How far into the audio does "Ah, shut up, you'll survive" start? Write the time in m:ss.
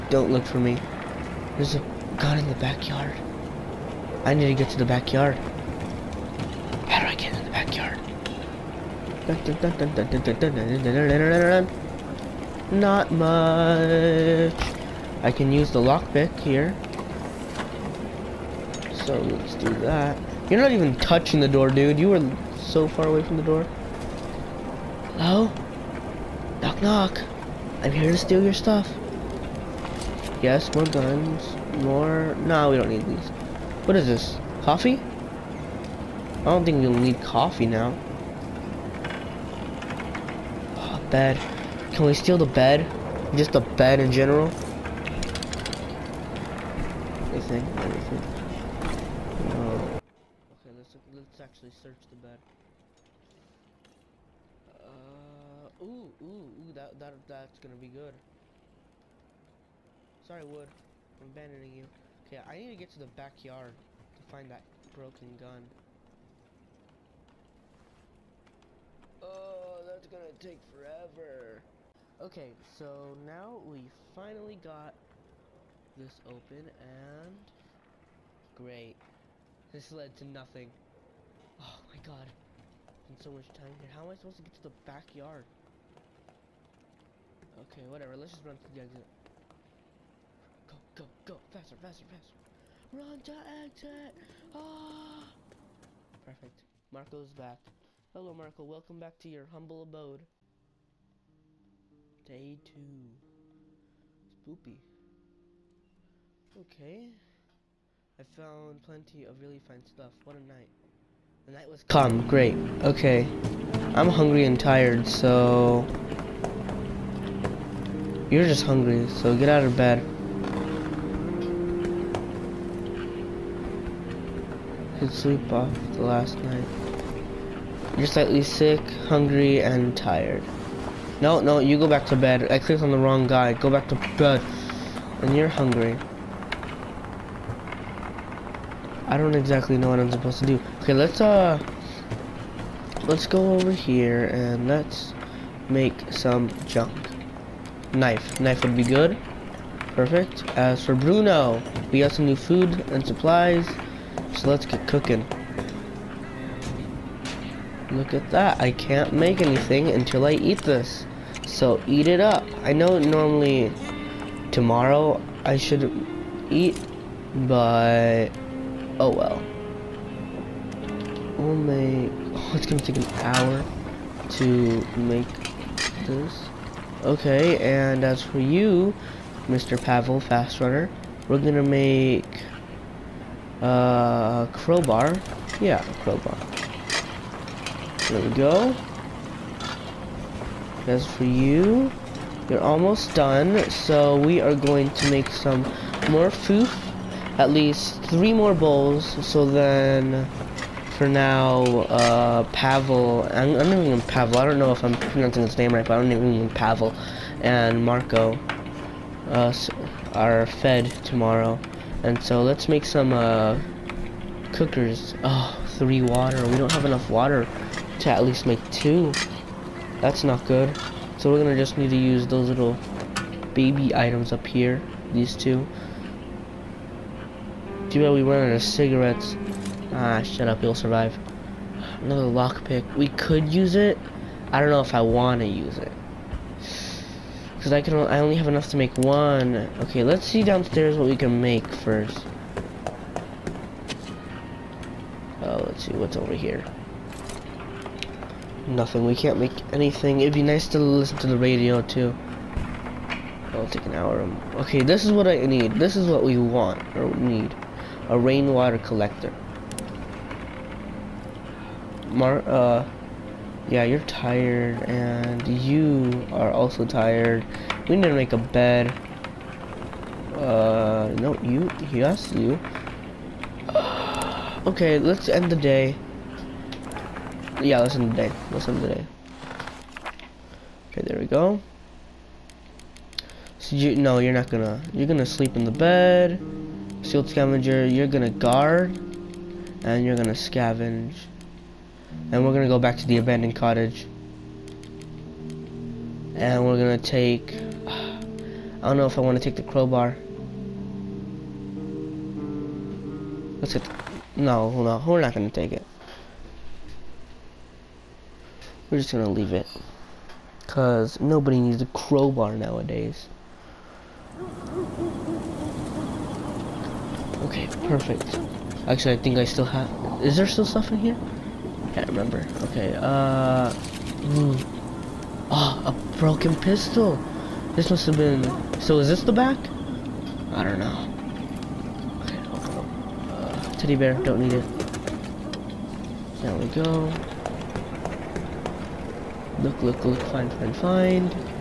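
3:49.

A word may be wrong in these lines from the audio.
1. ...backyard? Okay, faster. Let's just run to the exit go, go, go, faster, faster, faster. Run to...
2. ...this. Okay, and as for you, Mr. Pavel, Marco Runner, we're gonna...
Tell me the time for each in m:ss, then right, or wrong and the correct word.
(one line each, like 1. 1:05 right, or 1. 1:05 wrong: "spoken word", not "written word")
1. 1:24 wrong: "whatever", not "faster"
2. 2:56 wrong: "Fast", not "Marco".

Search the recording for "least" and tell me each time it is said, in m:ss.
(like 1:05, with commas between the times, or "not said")
3:17, 3:38.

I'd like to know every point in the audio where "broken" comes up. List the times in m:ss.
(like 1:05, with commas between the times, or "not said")
1:04, 5:26.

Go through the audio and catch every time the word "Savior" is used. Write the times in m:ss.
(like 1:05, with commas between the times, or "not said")
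not said.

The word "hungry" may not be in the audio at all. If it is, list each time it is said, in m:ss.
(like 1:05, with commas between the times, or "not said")
1:54, 1:58, 2:09, 2:15.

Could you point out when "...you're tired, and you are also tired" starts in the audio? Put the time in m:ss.
4:23.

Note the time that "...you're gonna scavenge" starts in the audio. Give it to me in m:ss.
4:50.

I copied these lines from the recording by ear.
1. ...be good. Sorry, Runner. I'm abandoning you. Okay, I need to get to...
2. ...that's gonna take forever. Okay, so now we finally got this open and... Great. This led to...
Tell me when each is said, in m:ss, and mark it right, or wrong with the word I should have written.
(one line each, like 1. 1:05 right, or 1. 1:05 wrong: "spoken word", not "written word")
1. 0:57 wrong: "Wood", not "Runner"
2. 1:09 right.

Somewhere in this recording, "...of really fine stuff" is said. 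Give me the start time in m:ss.
1:49.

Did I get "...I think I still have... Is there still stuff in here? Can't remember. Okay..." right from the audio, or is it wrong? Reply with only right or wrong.
right.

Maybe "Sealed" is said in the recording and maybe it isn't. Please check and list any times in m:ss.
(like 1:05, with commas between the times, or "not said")
4:47.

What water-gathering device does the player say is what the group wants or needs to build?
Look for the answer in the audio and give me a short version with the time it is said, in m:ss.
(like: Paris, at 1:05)
Rainwater collector, at 4:18.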